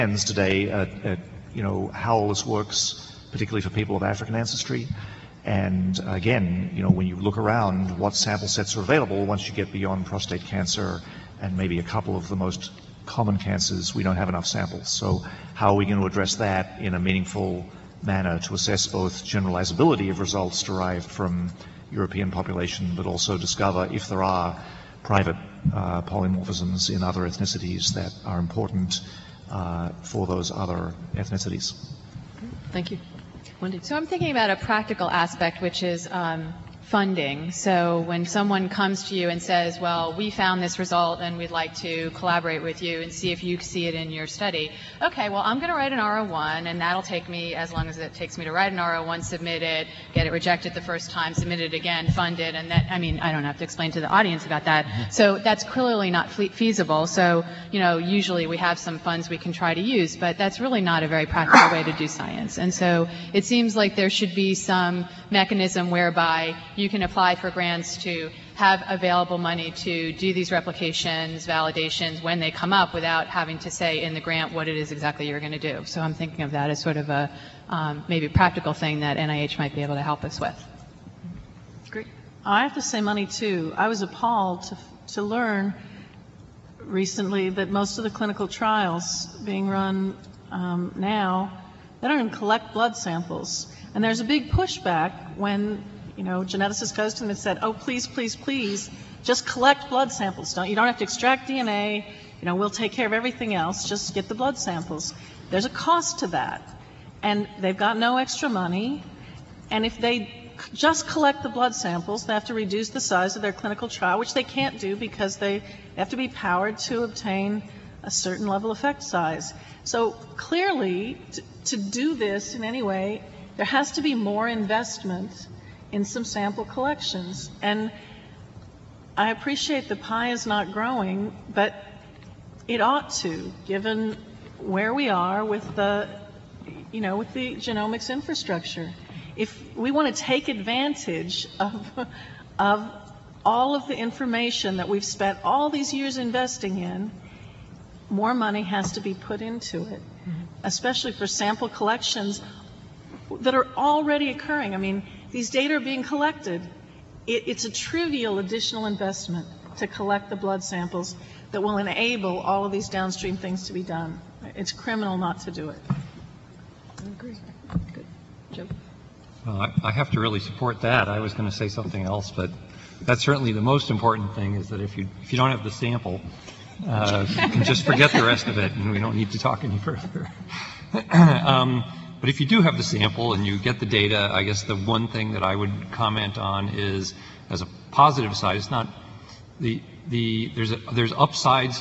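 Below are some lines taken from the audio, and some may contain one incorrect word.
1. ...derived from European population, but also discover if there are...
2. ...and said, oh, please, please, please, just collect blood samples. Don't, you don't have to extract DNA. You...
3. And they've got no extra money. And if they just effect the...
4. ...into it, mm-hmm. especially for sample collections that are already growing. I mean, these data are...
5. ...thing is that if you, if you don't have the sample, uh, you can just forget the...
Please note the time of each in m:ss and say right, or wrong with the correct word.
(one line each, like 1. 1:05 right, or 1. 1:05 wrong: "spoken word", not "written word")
1. 0:20 right
2. 1:37 right
3. 1:47 wrong: "collect", not "effect"
4. 2:29 wrong: "occurring", not "growing"
5. 2:54 right.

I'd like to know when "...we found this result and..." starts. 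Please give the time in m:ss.
0:40.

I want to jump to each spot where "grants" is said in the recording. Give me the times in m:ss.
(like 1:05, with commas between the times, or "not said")
1:07, 1:14.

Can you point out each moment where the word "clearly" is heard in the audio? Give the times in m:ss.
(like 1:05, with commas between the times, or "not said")
0:55, 2:00.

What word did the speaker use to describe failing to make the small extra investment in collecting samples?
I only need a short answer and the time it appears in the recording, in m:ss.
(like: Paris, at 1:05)
criminal, at 2:44.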